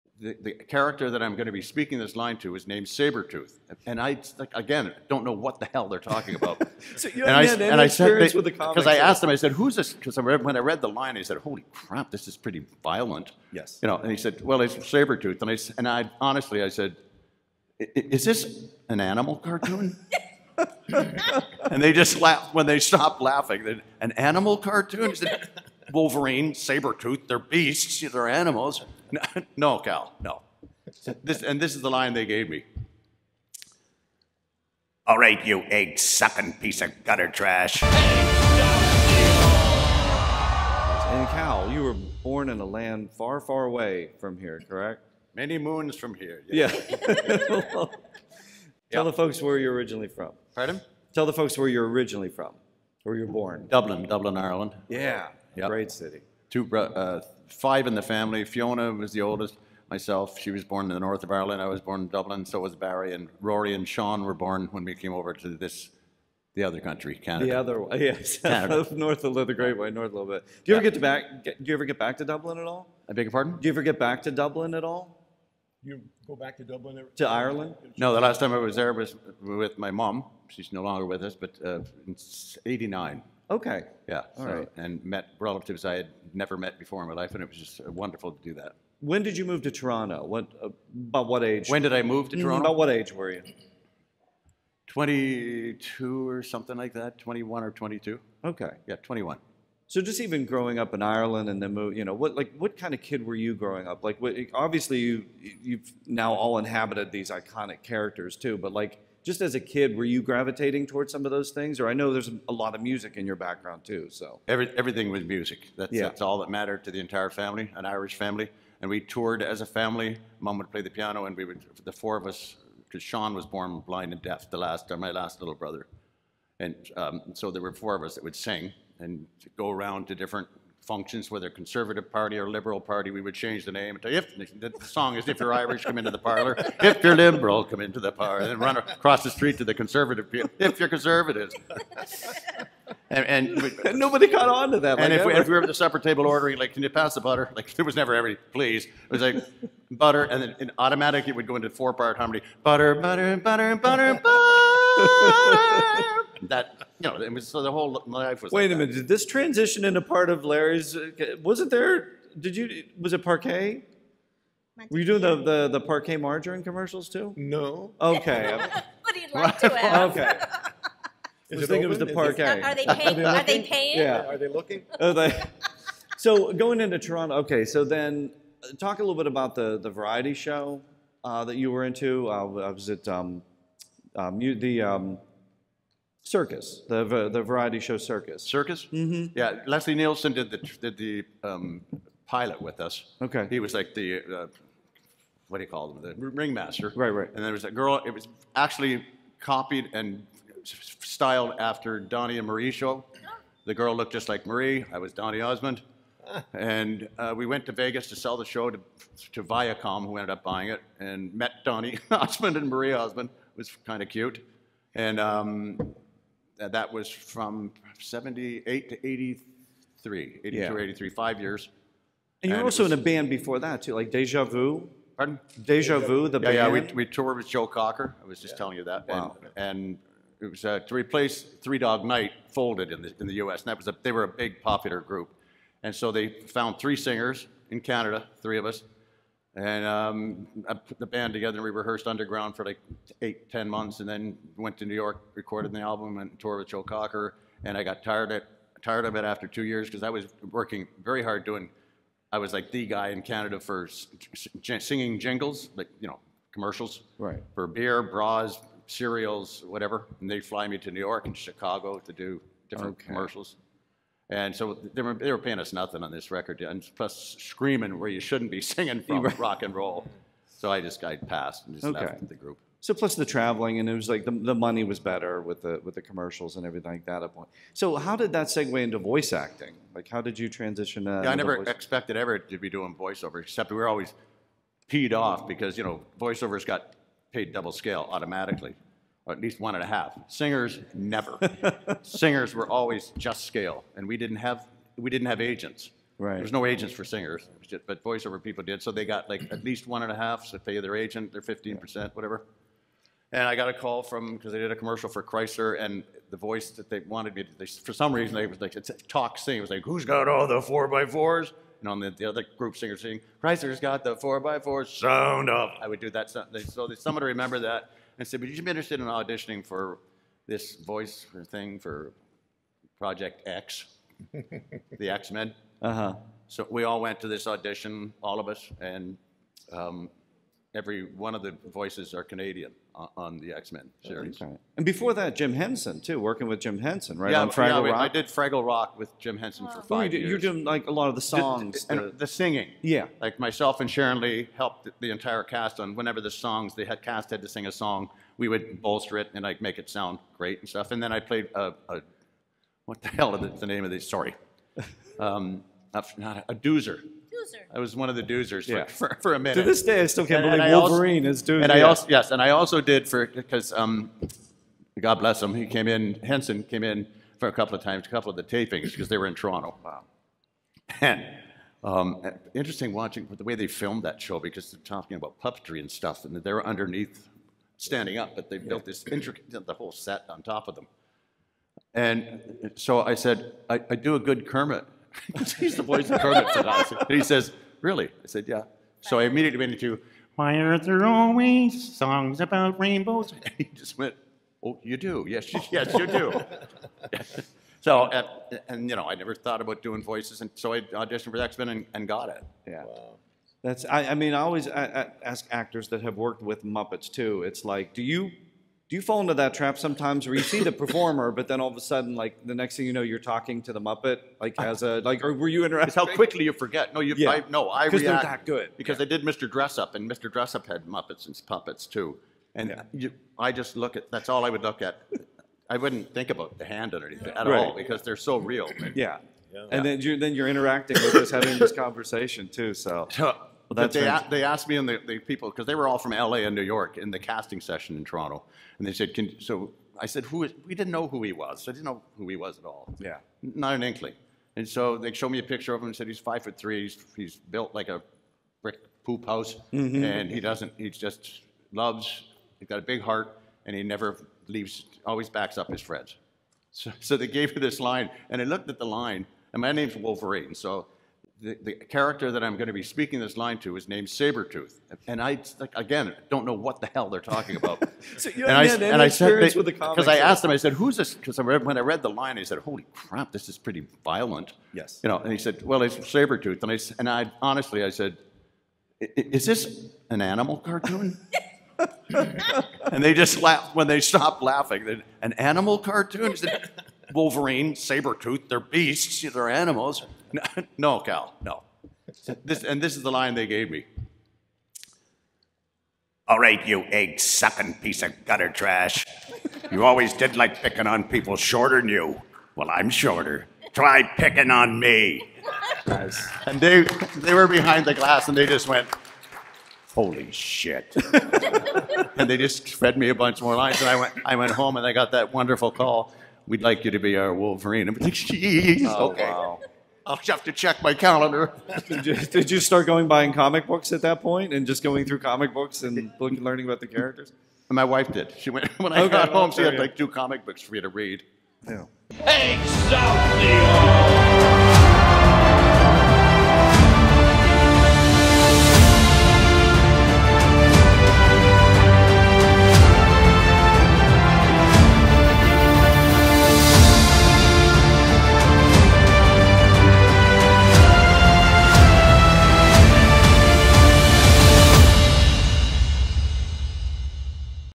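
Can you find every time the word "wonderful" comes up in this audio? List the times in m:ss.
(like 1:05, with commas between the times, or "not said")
1:27, 8:35.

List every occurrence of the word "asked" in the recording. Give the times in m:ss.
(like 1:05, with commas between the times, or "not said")
0:08, 7:14, 7:50.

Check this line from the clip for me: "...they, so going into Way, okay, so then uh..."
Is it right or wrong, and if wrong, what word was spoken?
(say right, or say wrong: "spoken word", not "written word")
wrong: "Toronto", not "Way".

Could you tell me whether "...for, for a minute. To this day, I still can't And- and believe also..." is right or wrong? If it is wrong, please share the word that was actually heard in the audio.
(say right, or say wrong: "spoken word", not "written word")
right.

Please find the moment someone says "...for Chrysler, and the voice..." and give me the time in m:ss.
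5:05.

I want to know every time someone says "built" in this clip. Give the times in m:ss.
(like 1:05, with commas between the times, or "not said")
6:18, 7:27.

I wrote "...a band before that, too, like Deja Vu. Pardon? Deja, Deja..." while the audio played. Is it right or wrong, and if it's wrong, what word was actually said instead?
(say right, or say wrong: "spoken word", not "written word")
right.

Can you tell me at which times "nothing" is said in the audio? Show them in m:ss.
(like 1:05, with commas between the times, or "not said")
4:25.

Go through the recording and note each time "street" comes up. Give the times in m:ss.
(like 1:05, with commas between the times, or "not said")
2:19.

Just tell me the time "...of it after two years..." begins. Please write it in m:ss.
4:09.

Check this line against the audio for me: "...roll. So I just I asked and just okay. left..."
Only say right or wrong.
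wrong.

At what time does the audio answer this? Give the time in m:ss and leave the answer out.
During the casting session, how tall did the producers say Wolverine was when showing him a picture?
7:26.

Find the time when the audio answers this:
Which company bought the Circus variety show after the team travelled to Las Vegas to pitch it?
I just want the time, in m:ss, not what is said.
3:29.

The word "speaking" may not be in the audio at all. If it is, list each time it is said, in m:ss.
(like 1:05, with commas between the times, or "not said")
0:01, 7:42.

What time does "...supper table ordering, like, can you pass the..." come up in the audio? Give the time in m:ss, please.
2:25.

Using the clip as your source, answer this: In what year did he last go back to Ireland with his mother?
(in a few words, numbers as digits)
1989.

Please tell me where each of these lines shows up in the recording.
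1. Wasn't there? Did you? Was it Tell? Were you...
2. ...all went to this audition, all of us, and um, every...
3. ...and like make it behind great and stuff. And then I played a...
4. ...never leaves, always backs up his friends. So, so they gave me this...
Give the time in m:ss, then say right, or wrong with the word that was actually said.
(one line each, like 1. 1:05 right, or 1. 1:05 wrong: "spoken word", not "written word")
1. 2:41 wrong: "Parkay", not "Tell"
2. 5:26 right
3. 5:49 wrong: "sound", not "behind"
4. 7:33 right.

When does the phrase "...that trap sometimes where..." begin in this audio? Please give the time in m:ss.
6:49.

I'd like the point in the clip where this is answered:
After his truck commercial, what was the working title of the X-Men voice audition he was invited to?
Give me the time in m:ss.
5:22.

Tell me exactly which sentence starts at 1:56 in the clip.
that's all that mattered to the entire family, an Irish family.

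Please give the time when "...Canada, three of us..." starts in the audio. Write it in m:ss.
3:57.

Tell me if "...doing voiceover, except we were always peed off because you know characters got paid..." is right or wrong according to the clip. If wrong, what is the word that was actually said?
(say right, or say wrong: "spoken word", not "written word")
wrong: "voiceovers", not "characters".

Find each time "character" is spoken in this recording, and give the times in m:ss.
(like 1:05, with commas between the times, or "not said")
0:00, 1:47, 7:41, 8:46.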